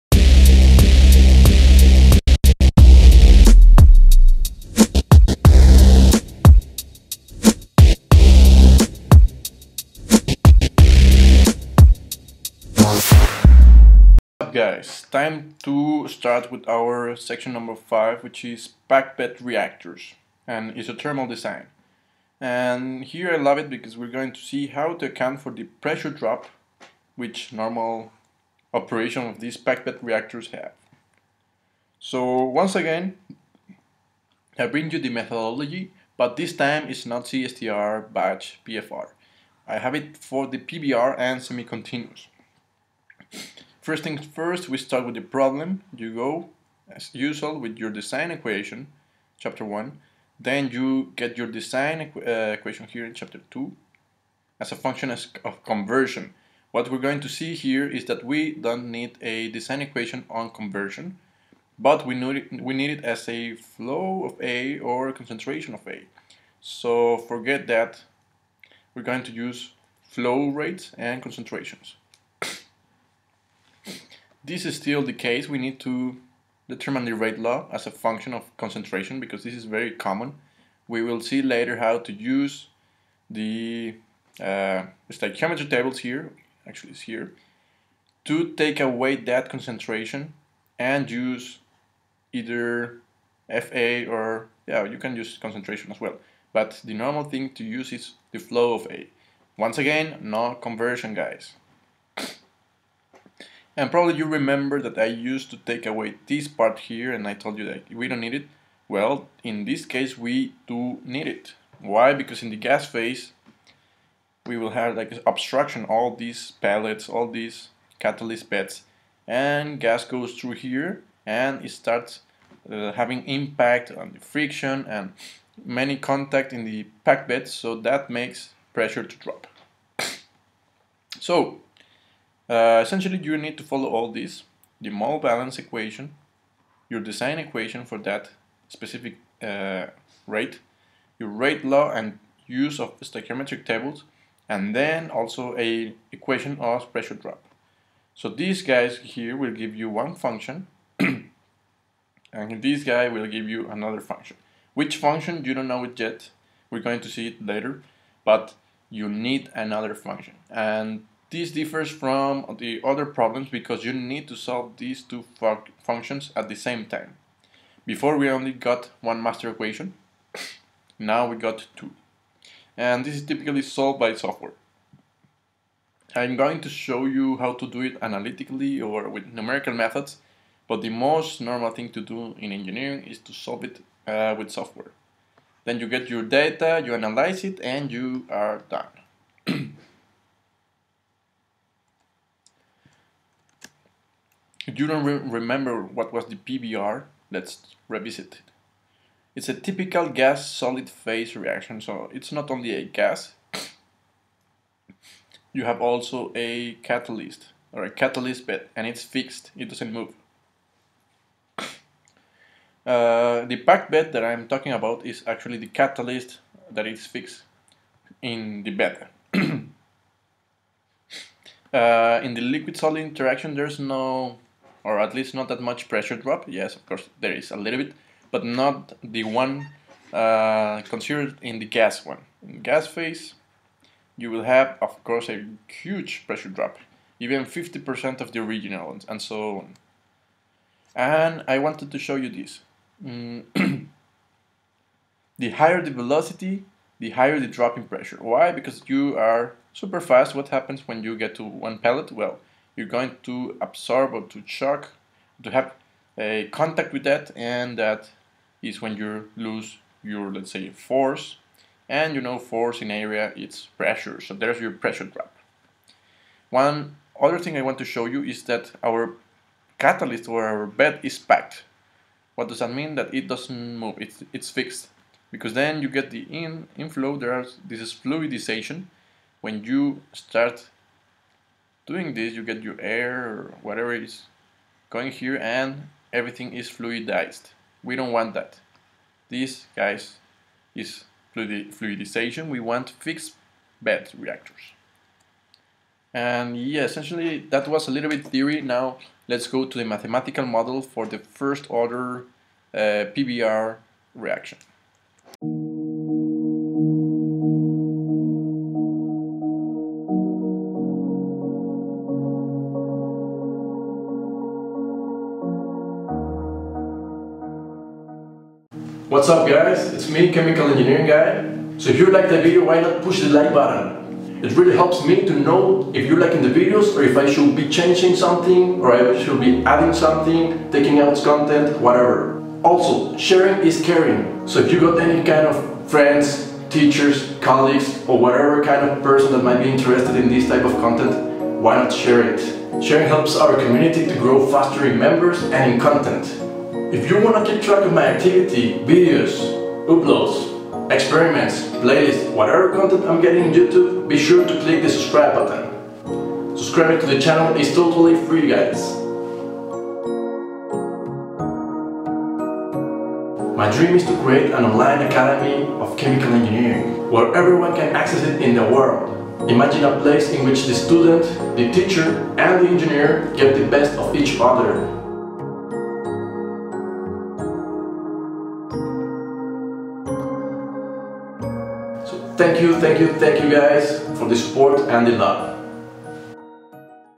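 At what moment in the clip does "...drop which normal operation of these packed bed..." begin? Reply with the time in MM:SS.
00:26.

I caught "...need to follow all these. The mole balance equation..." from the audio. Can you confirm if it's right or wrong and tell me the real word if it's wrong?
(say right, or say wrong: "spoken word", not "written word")
right.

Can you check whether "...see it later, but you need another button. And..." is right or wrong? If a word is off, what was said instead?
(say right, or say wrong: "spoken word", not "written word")
wrong: "function", not "button".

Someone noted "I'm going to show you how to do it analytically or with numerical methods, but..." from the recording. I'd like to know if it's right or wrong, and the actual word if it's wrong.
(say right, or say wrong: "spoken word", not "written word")
right.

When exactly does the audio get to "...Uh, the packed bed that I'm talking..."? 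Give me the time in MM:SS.
03:32.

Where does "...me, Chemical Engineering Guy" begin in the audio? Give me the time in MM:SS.
05:20.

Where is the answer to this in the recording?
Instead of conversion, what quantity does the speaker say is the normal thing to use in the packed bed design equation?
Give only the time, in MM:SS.
01:38.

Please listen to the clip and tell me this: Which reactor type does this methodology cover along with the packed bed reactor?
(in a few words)
semi-continuous.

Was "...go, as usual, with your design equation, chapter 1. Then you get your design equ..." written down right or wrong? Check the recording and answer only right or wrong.
right.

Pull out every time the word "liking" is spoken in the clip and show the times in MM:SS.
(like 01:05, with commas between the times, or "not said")
05:26.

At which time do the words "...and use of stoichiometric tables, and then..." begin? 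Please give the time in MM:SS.
02:21.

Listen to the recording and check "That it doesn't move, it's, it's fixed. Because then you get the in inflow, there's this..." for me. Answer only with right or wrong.
right.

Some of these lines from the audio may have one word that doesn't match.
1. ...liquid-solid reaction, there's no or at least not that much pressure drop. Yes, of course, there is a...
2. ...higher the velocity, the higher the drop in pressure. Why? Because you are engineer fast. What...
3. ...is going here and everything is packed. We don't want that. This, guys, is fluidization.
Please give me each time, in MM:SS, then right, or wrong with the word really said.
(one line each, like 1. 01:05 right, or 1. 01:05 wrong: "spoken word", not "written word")
1. 03:42 wrong: "interaction", not "reaction"
2. 04:05 wrong: "super", not "engineer"
3. 04:43 wrong: "fluidized", not "packed".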